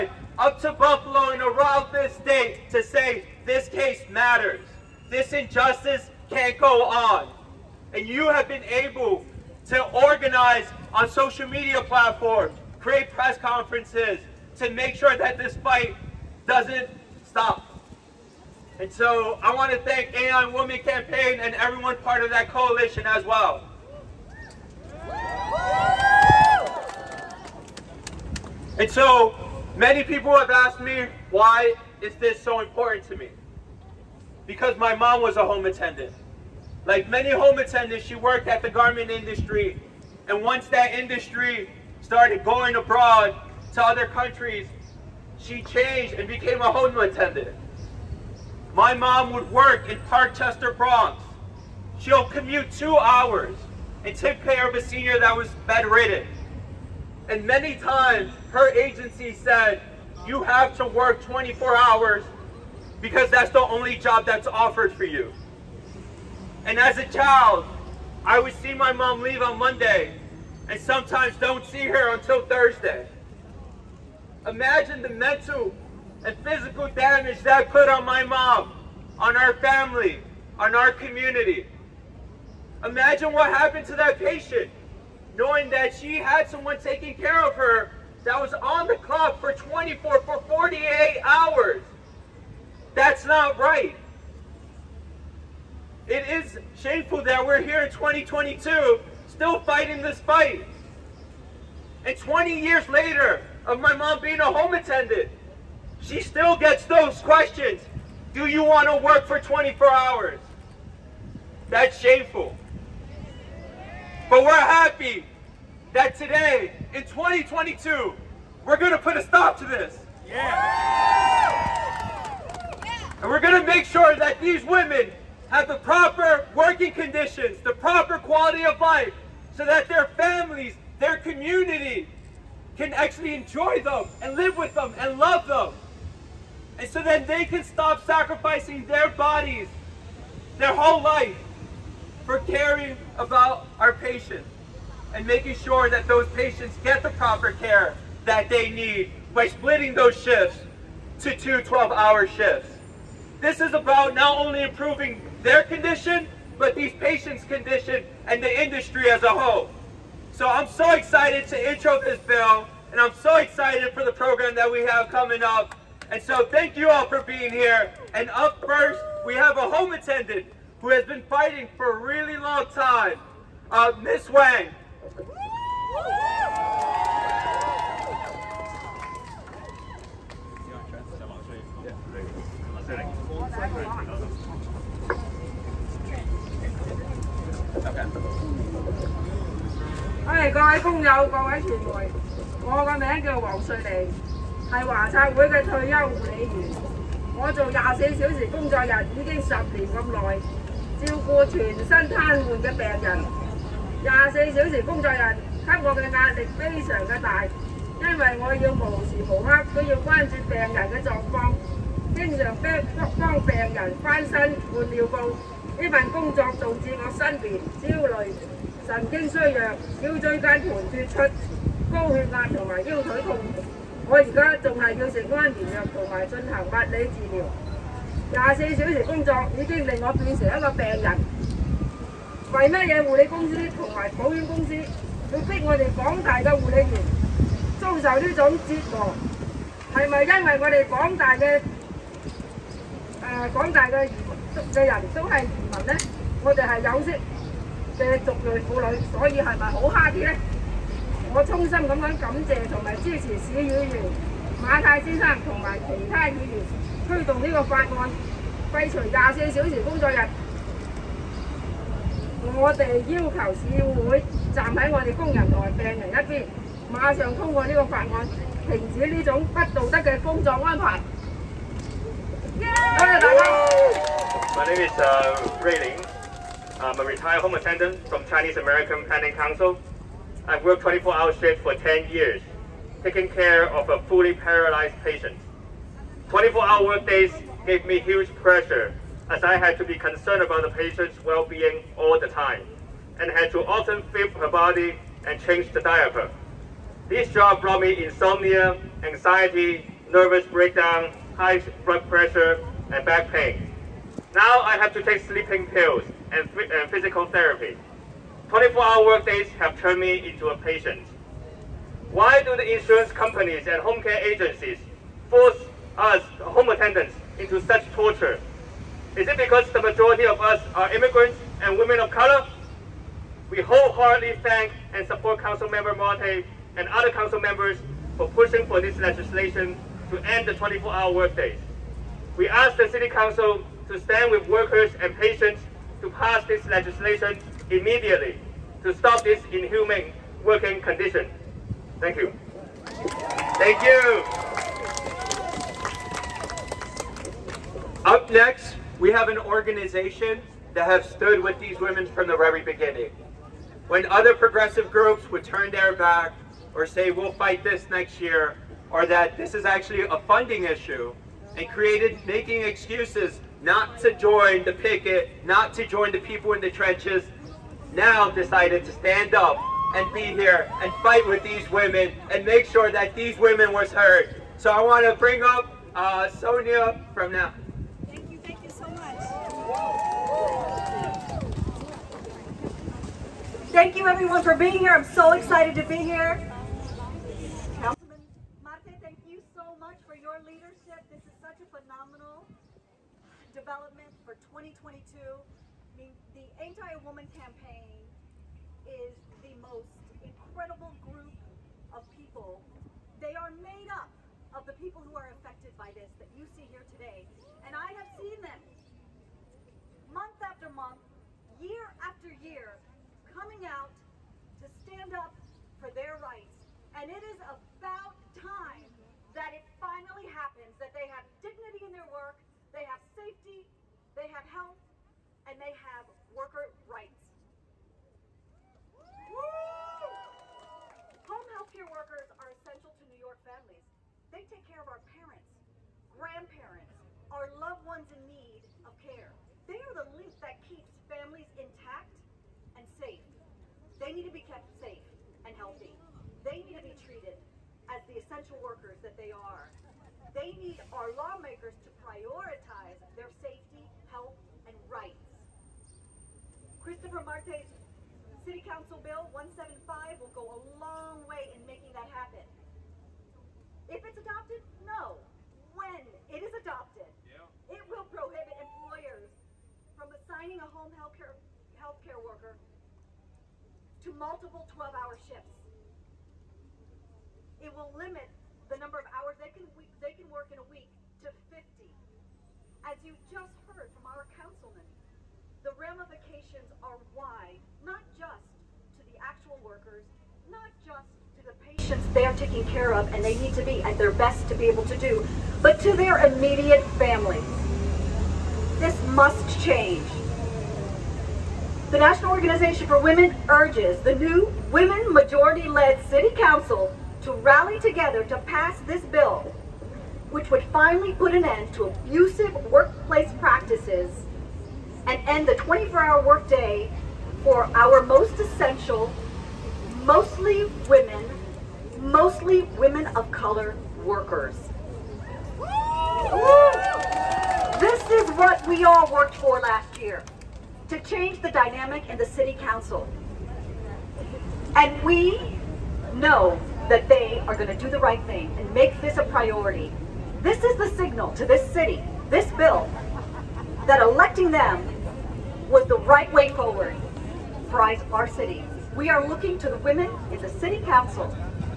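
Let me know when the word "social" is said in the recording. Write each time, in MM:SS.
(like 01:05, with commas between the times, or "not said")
00:11.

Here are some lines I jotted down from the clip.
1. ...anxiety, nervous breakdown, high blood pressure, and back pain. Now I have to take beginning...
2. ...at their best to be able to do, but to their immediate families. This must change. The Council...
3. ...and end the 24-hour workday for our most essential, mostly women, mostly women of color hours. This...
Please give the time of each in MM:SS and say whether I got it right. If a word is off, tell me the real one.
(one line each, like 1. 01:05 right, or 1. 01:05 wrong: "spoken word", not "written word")
1. 04:59 wrong: "sleeping", not "beginning"
2. 08:13 wrong: "National", not "Council"
3. 08:35 wrong: "workers", not "hours".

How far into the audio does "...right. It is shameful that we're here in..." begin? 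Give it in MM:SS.
01:33.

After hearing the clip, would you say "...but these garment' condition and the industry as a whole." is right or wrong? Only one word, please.
wrong.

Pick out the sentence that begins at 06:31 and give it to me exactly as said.
This is such a phenomenal development for 2022.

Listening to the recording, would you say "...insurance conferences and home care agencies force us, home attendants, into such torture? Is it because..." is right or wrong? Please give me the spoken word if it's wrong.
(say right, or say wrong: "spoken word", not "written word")
wrong: "companies", not "conferences".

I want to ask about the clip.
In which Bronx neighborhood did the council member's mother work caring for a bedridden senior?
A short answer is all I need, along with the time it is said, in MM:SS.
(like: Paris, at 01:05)
Parkchester, at 00:50.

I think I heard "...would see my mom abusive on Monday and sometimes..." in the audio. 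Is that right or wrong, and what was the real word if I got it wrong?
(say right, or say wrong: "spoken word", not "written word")
wrong: "leave", not "abusive".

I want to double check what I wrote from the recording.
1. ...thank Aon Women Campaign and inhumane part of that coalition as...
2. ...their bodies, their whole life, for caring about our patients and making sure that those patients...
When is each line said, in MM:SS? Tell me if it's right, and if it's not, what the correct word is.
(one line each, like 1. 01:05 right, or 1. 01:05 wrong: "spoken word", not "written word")
1. 00:19 wrong: "everyone", not "inhumane"
2. 02:18 right.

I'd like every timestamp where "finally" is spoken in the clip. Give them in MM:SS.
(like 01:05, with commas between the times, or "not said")
06:59, 08:30.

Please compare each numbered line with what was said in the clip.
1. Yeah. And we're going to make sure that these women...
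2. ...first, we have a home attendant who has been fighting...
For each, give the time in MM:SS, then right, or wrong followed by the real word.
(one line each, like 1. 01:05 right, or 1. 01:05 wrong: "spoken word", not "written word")
1. 02:00 right
2. 02:48 right.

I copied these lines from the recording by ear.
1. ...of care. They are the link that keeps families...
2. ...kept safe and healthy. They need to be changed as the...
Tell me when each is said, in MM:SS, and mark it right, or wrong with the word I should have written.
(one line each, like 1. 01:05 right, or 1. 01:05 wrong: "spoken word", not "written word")
1. 07:18 right
2. 07:24 wrong: "treated", not "changed".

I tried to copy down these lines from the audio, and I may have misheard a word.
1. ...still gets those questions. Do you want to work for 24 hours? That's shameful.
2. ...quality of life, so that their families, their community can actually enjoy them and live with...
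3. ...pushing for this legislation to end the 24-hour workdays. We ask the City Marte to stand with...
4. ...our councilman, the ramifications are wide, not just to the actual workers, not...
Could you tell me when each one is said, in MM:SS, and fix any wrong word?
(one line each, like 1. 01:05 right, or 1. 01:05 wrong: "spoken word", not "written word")
1. 01:46 right
2. 02:08 right
3. 05:28 wrong: "Council", not "Marte"
4. 08:04 right.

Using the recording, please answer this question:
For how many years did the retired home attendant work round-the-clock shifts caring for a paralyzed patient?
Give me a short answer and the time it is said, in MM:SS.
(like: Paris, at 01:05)
10, at 04:41.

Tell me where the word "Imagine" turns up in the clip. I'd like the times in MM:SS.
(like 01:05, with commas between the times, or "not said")
01:14, 01:22.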